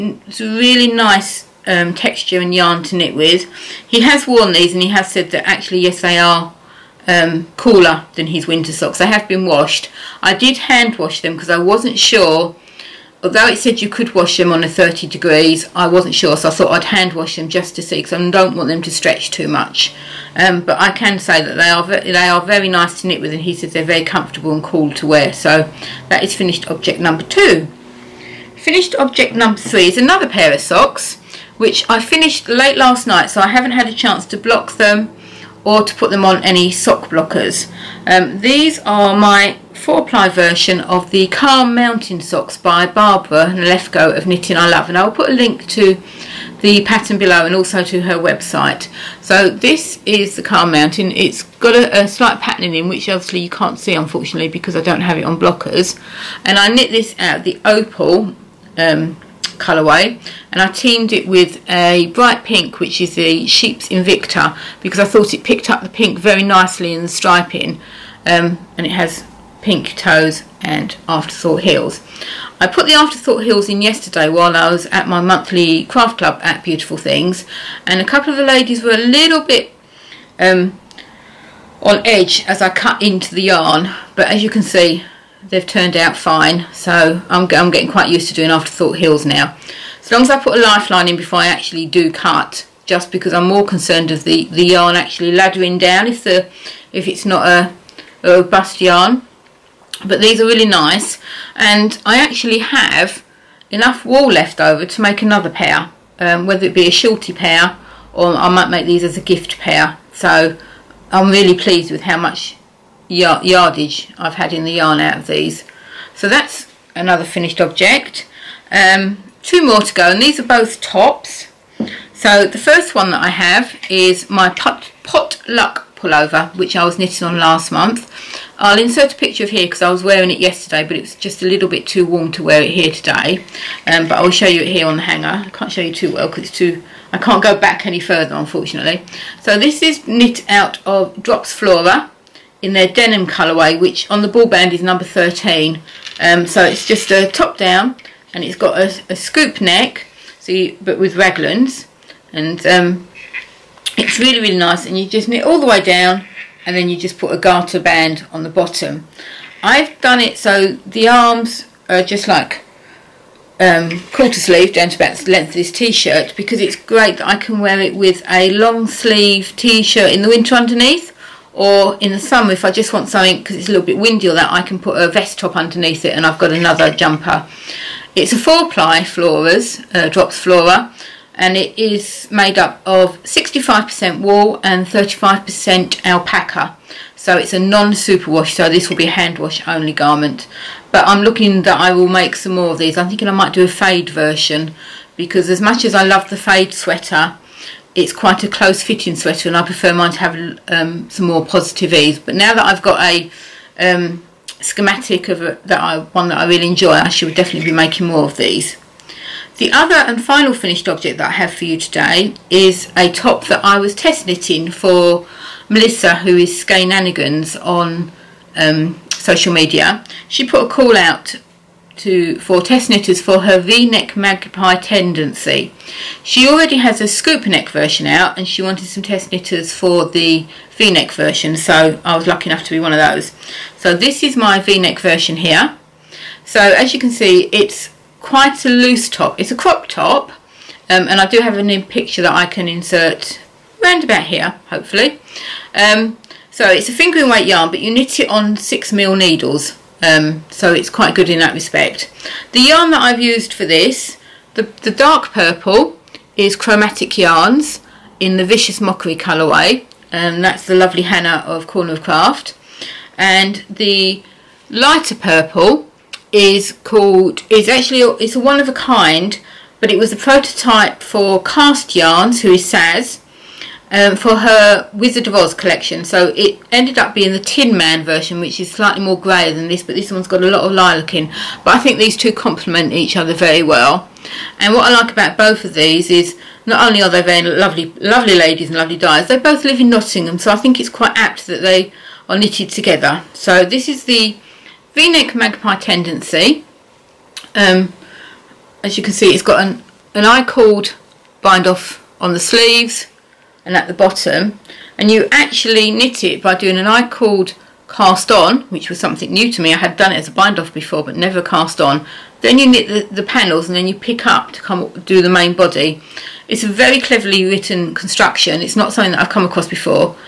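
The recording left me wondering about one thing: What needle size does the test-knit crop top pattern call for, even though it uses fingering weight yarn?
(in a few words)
6mm.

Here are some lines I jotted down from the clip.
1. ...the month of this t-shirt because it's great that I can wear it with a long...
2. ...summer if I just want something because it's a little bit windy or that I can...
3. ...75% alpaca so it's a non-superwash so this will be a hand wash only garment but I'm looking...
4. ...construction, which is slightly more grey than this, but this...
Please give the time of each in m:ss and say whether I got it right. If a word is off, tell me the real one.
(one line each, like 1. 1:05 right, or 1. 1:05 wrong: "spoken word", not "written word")
1. 2:45 wrong: "length", not "month"
2. 2:52 right
3. 3:04 wrong: "35", not "75"
4. 4:38 wrong: "version", not "construction".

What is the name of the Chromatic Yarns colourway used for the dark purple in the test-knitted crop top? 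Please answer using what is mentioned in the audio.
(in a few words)
Vicious Mockery.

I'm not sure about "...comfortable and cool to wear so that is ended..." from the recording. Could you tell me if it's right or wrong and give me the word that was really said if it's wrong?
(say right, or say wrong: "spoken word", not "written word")
wrong: "finished", not "ended".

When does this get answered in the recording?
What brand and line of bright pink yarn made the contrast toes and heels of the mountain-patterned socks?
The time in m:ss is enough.
1:03.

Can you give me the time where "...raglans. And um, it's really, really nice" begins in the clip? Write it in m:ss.
2:31.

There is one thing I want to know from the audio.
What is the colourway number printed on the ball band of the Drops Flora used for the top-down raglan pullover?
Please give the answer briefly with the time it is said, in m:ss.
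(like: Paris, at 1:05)
13, at 2:25.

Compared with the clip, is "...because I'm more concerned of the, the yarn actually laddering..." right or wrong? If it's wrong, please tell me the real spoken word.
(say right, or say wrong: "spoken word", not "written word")
right.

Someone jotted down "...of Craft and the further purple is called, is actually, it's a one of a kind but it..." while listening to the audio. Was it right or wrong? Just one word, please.
wrong.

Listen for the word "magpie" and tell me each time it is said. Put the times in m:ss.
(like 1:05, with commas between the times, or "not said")
3:44, 4:55.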